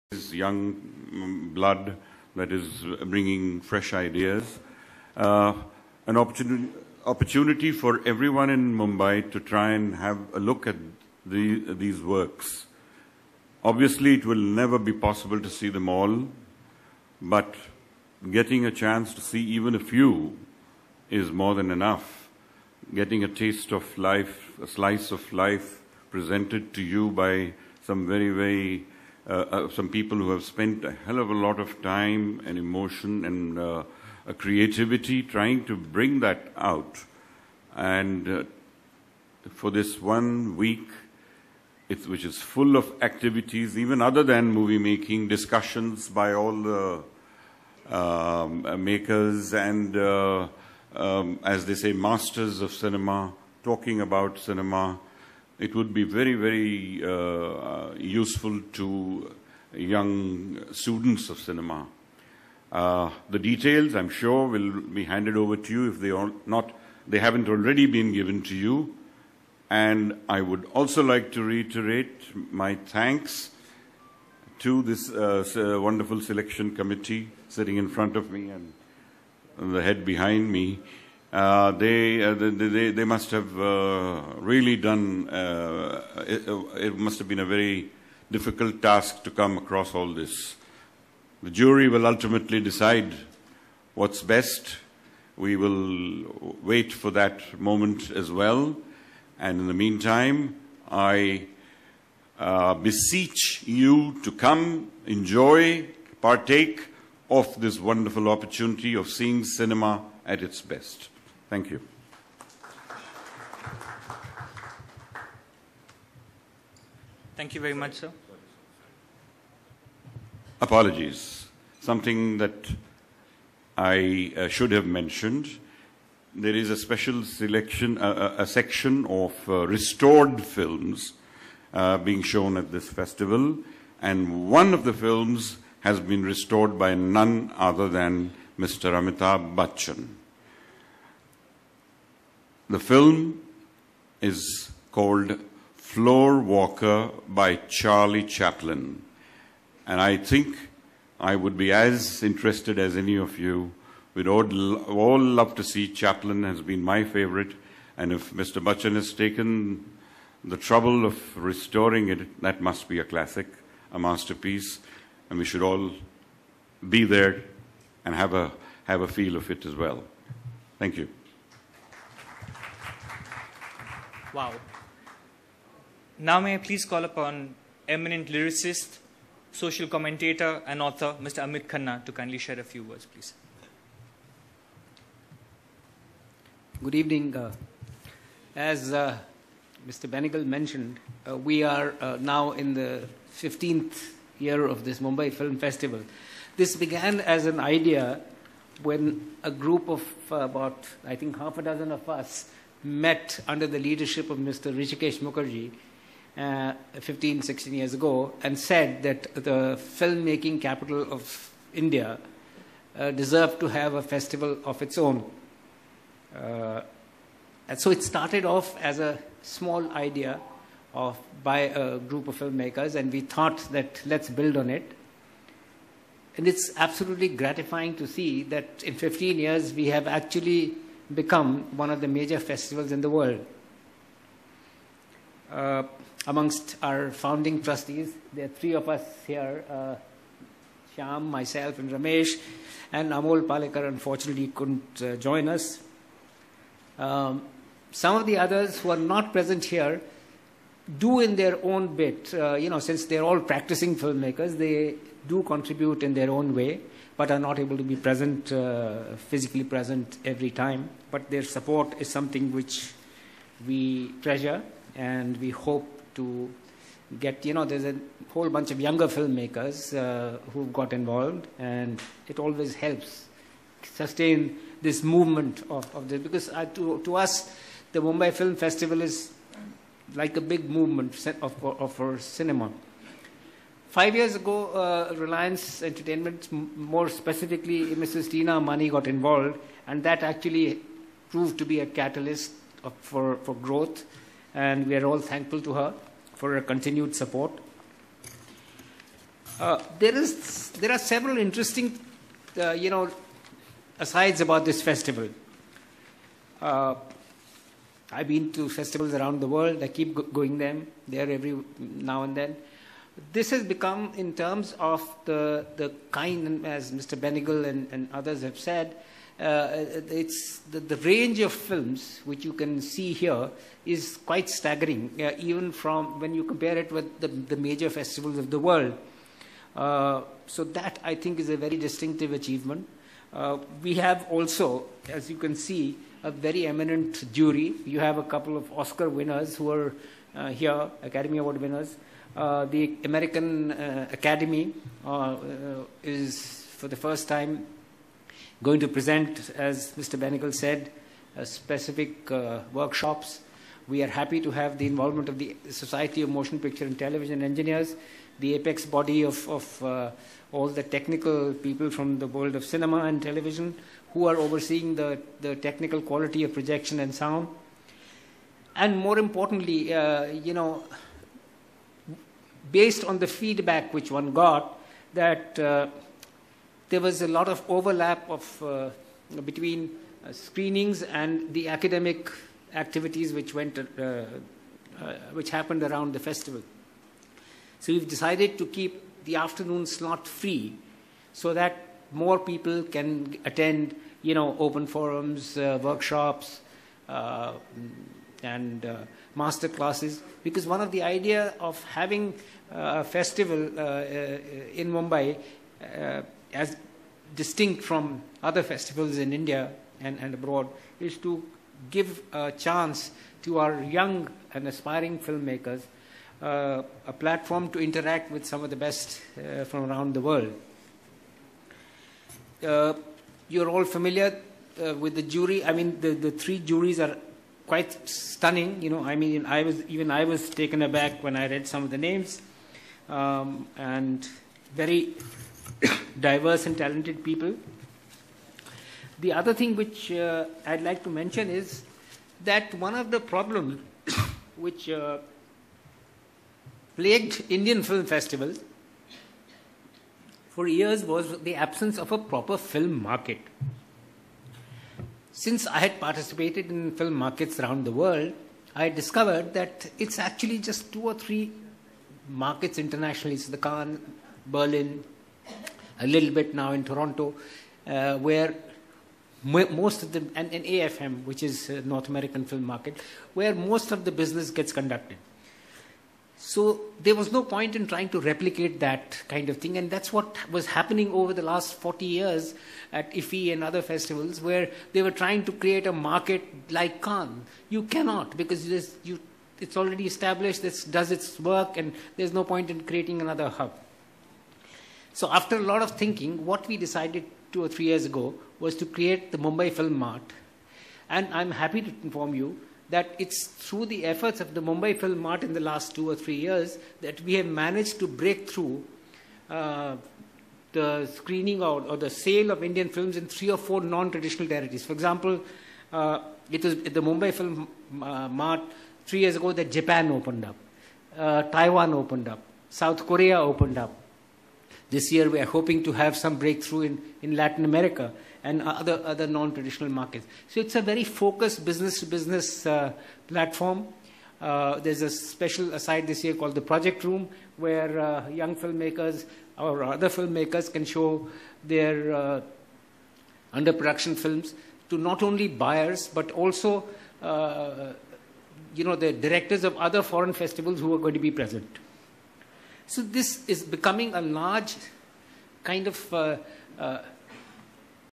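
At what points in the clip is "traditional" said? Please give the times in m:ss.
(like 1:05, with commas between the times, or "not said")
8:33, 8:49.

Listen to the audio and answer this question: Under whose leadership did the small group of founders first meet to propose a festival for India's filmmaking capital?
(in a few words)
Hrishikesh Mukherjee.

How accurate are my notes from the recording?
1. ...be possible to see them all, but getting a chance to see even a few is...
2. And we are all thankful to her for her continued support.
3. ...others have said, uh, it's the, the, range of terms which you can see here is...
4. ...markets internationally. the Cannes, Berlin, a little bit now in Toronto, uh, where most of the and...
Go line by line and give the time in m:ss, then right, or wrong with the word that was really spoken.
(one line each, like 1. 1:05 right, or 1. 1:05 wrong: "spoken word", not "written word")
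1. 0:14 right
2. 4:54 right
3. 5:18 wrong: "films", not "terms"
4. 7:42 right.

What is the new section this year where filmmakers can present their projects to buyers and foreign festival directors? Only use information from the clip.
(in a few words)
Project Room.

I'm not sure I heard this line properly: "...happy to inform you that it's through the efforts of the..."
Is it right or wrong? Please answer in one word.
right.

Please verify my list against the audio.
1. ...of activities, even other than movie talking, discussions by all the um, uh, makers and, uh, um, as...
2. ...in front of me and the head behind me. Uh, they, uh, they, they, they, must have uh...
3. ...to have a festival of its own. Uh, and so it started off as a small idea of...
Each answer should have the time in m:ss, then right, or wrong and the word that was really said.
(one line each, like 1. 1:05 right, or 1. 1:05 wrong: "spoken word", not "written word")
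1. 0:42 wrong: "making", not "talking"
2. 1:17 right
3. 3:33 right.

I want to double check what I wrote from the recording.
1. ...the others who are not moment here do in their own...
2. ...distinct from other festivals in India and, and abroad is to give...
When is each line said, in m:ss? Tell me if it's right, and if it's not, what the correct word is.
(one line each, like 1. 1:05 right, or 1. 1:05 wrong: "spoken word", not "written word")
1. 4:08 wrong: "present", not "moment"
2. 6:47 right.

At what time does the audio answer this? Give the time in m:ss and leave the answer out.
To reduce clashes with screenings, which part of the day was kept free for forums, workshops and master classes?
6:29.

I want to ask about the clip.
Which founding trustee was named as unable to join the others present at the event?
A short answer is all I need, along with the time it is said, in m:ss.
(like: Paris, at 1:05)
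Amol Palekar, at 4:03.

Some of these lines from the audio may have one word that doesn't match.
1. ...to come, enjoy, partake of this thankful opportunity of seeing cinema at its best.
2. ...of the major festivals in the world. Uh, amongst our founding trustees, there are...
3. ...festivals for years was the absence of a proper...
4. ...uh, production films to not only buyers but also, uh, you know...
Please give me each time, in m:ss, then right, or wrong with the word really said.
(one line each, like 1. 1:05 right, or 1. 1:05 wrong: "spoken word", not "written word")
1. 1:44 wrong: "wonderful", not "thankful"
2. 3:51 right
3. 7:28 right
4. 9:02 right.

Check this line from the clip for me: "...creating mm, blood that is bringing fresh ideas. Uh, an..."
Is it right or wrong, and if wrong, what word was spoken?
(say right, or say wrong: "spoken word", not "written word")
wrong: "young", not "creating".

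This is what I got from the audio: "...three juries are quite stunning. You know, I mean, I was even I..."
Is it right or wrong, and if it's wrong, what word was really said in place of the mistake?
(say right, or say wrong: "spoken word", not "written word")
right.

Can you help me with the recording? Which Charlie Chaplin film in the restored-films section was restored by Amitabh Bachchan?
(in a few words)
Floorwalker.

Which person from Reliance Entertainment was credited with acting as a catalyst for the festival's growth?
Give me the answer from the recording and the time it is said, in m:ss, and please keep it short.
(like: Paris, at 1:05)
Tina Ambani, at 4:47.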